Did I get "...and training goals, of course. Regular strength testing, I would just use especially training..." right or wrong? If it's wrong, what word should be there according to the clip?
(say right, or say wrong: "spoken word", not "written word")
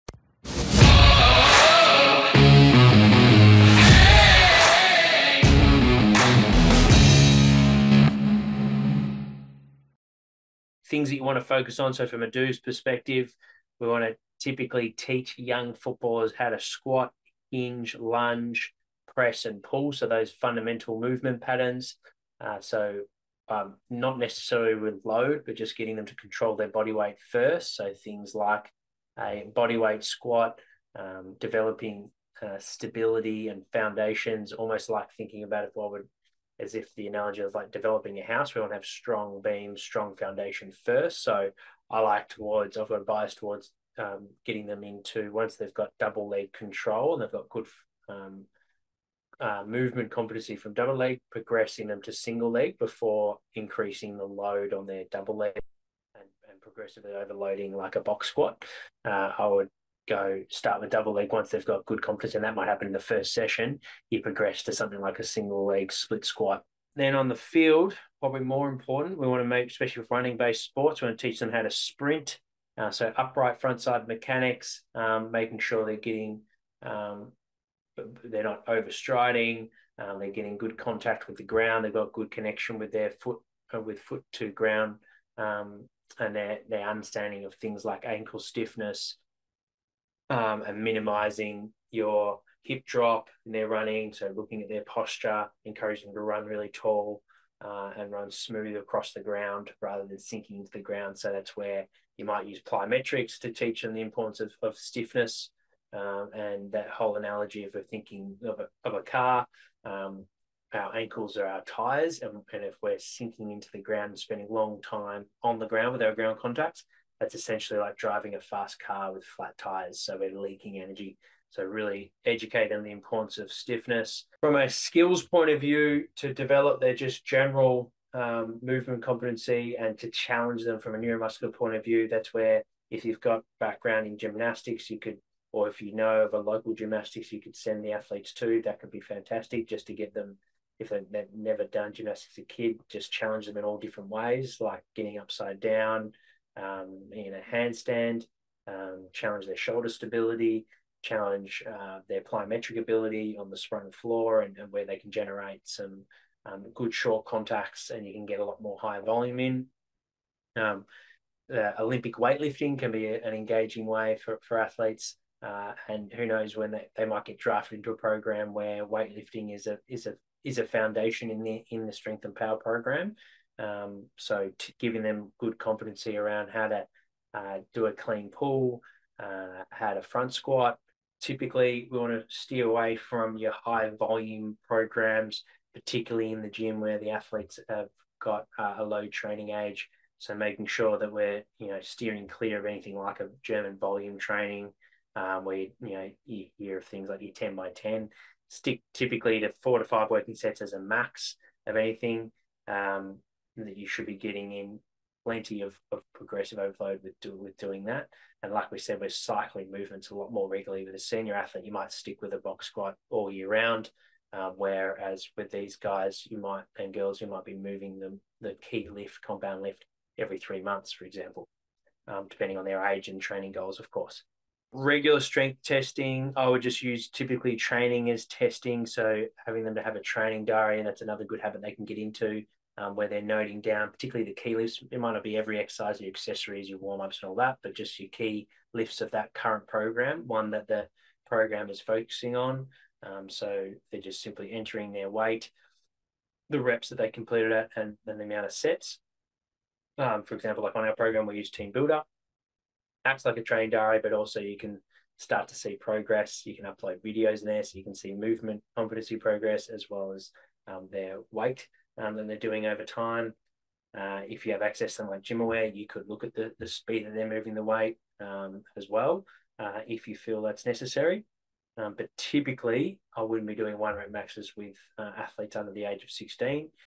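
wrong: "typically", not "especially".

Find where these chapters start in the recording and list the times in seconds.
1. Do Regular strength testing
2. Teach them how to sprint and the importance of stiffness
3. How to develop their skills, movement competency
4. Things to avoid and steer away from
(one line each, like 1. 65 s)
1. 225 s
2. 65 s
3. 124 s
4. 180 s.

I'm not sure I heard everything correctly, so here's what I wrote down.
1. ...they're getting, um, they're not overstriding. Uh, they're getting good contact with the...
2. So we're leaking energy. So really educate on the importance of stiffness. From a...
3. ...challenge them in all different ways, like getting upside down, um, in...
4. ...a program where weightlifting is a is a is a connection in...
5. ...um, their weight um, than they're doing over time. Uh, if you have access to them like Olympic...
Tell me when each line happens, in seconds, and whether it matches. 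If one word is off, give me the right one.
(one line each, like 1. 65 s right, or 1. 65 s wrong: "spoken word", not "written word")
1. 75 s right
2. 119 s right
3. 143 s right
4. 167 s wrong: "foundation", not "connection"
5. 260 s wrong: "GymAware", not "Olympic".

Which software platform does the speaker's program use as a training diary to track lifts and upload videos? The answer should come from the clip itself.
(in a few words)
TeamBuildr.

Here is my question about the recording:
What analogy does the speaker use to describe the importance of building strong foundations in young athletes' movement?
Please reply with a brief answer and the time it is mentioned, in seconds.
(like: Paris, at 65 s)
Developing a house, at 37 s.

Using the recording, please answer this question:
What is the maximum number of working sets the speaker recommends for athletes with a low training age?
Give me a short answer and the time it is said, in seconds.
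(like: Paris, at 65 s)
4 to 5, at 199 s.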